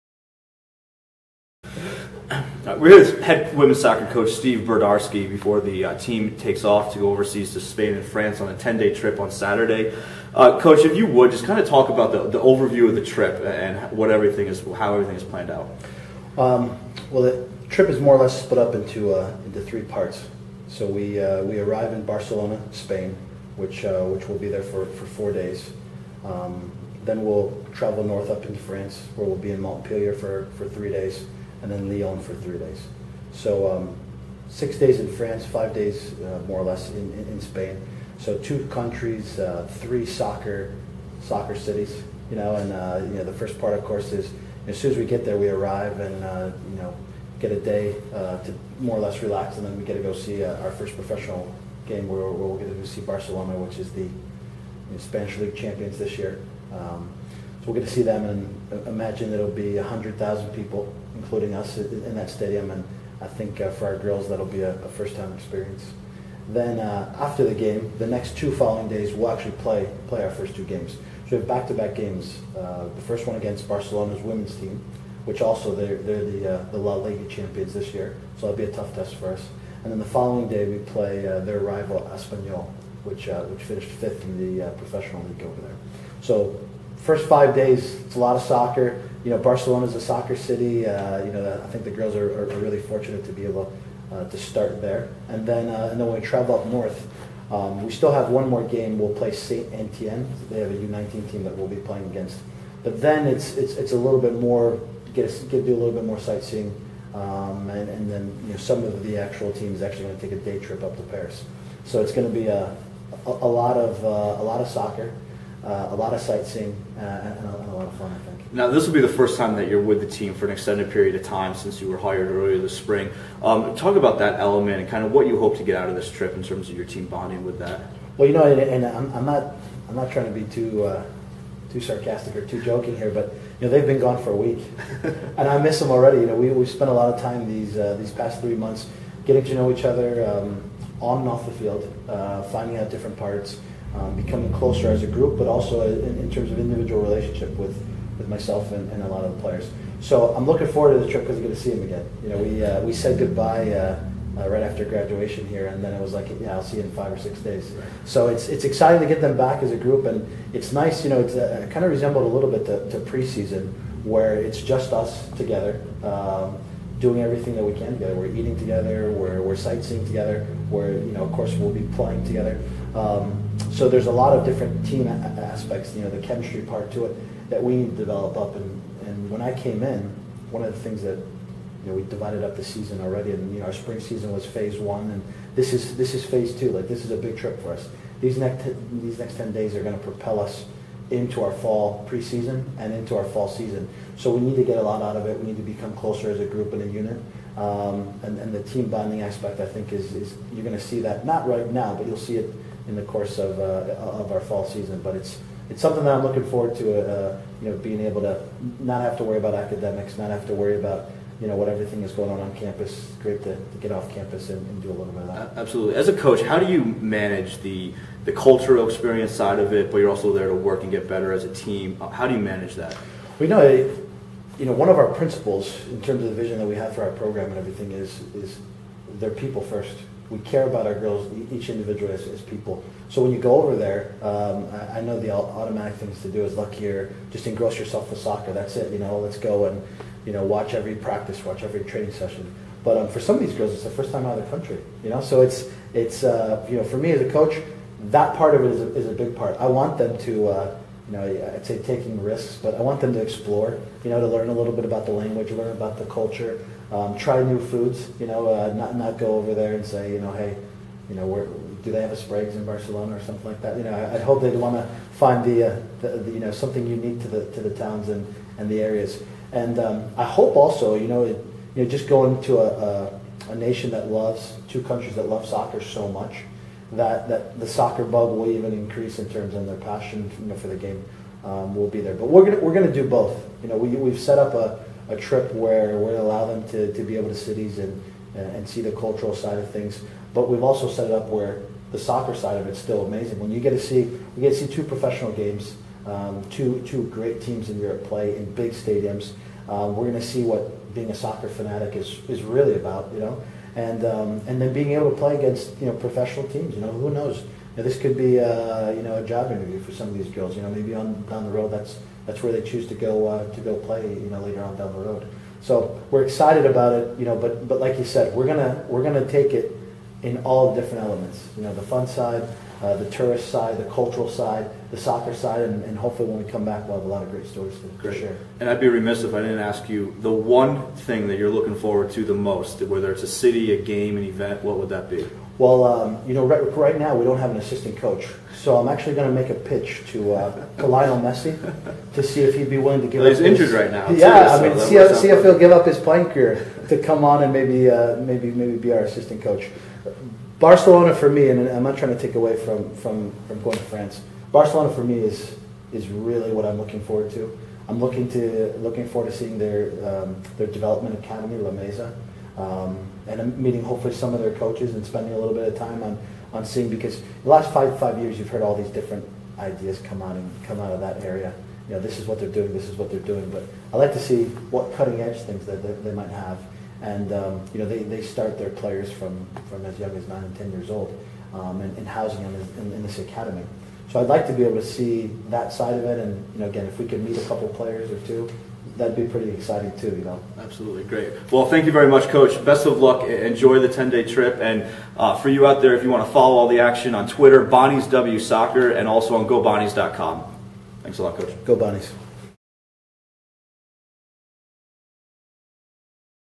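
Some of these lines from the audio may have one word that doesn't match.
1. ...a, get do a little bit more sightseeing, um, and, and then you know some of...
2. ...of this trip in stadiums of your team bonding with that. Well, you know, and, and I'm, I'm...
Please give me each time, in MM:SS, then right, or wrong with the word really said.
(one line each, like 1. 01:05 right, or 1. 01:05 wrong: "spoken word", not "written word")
1. 01:45 right
2. 02:05 wrong: "terms", not "stadiums".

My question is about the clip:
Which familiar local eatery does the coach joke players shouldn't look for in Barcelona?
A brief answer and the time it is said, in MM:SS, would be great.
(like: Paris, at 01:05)
Sprague's, at 04:22.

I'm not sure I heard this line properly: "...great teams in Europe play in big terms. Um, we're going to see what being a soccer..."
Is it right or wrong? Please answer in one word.
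wrong.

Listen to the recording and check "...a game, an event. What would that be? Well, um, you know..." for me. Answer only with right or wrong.
right.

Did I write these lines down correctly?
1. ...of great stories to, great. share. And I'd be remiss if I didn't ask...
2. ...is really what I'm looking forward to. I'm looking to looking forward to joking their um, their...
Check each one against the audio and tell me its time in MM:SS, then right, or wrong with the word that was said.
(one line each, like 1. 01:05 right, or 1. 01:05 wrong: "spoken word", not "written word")
1. 05:27 right
2. 05:55 wrong: "seeing", not "joking".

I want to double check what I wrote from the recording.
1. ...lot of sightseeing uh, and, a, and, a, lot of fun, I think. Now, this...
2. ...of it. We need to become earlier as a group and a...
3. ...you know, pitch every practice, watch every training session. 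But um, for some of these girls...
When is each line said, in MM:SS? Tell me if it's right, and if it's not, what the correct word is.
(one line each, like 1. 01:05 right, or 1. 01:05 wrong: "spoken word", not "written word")
1. 01:55 right
2. 03:15 wrong: "closer", not "earlier"
3. 04:00 wrong: "watch", not "pitch".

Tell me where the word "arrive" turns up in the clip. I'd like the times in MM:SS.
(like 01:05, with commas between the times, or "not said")
00:21, 00:45.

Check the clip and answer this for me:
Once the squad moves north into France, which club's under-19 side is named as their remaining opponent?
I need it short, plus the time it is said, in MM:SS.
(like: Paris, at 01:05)
Saint Etienne, at 01:39.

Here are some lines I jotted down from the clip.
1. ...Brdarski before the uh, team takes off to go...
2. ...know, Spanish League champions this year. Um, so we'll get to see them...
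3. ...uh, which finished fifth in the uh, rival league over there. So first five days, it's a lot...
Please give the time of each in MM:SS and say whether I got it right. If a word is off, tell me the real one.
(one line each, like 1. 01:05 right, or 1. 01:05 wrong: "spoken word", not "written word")
1. 00:04 right
2. 00:54 right
3. 01:23 wrong: "professional", not "rival".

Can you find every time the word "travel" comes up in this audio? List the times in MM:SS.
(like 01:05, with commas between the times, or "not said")
00:27, 01:36.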